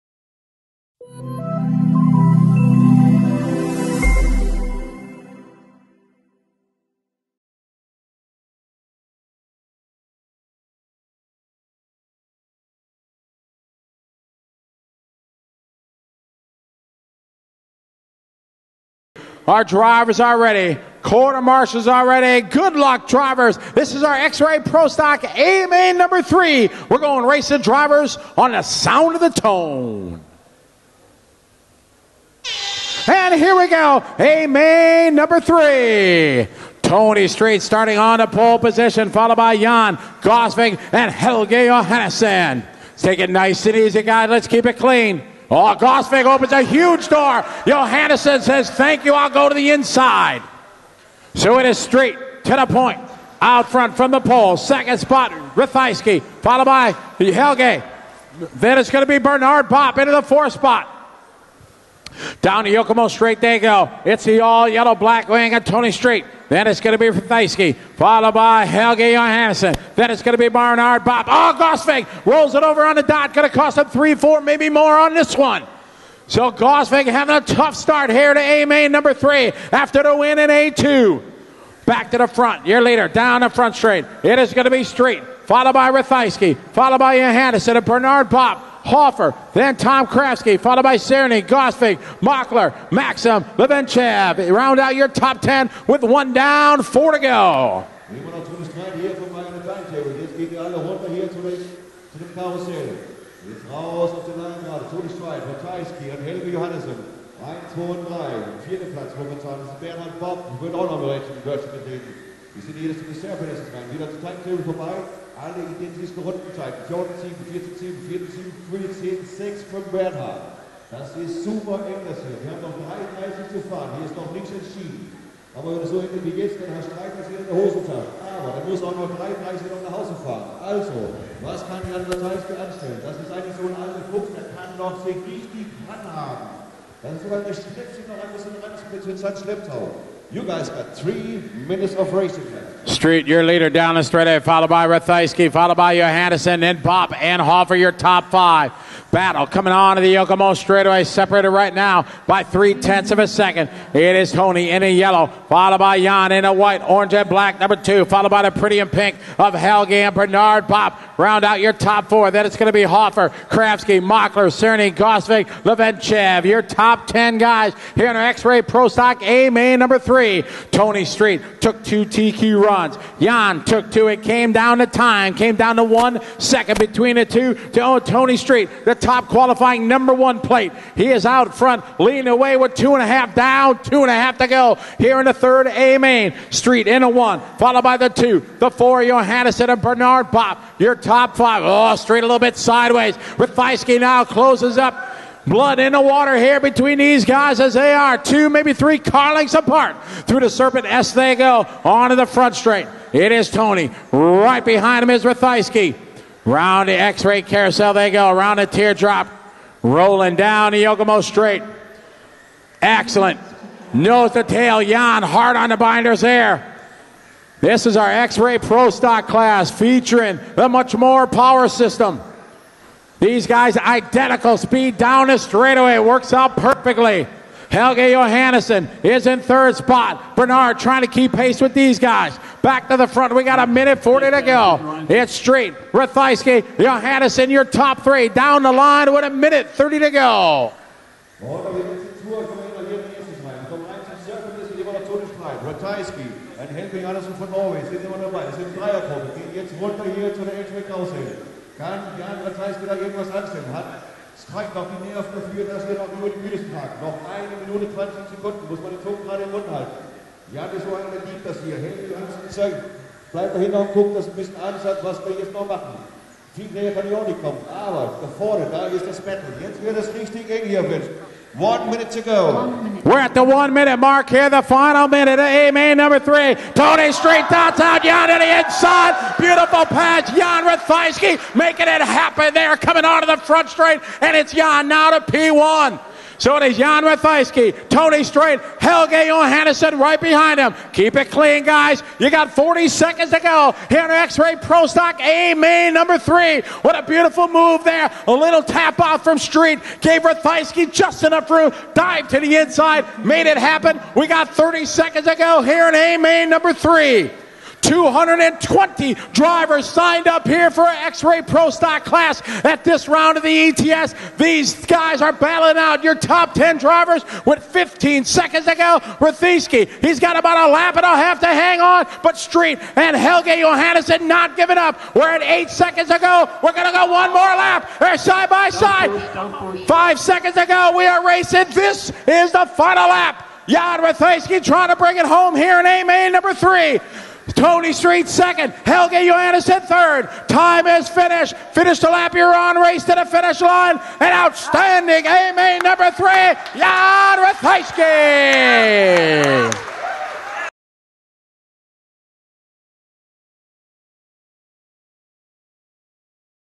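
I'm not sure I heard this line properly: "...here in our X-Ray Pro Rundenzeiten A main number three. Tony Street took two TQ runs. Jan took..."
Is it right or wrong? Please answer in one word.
wrong.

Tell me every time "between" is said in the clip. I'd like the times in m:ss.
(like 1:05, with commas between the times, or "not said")
2:56, 3:16.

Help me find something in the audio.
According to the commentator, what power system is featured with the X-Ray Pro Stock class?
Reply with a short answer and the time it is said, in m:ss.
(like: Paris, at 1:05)
Muchmore, at 3:40.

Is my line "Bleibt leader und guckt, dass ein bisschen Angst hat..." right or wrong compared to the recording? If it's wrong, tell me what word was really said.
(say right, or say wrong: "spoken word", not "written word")
wrong: "dahinter", not "leader".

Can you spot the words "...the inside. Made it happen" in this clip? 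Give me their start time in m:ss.
5:02.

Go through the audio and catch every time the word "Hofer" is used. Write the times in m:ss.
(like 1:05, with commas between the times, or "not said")
2:27, 2:42.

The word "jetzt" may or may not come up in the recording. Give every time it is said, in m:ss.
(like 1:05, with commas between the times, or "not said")
2:06, 4:09, 4:25, 4:29.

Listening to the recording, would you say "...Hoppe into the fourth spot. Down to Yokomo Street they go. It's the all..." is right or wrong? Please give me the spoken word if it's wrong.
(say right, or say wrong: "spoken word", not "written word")
right.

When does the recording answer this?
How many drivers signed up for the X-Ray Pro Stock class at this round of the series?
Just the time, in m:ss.
5:07.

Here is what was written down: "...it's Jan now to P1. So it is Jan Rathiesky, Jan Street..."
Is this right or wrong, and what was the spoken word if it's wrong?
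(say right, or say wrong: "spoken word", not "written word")
wrong: "Tony", not "Jan".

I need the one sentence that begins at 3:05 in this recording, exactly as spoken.
A main Street in a one, followed by the two, the four, Johannessen and Bernard Hoppe.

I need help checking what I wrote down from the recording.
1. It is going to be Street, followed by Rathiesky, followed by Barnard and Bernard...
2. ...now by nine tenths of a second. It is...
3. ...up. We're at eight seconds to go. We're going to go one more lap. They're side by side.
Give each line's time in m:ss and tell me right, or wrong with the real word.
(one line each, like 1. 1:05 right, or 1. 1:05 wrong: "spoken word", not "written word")
1. 1:24 wrong: "Johannessen", not "Barnard"
2. 2:31 wrong: "three", not "nine"
3. 5:24 right.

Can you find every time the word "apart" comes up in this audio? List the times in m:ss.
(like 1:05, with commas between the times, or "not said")
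3:19.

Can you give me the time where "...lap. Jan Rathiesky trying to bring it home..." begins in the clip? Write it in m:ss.
5:33.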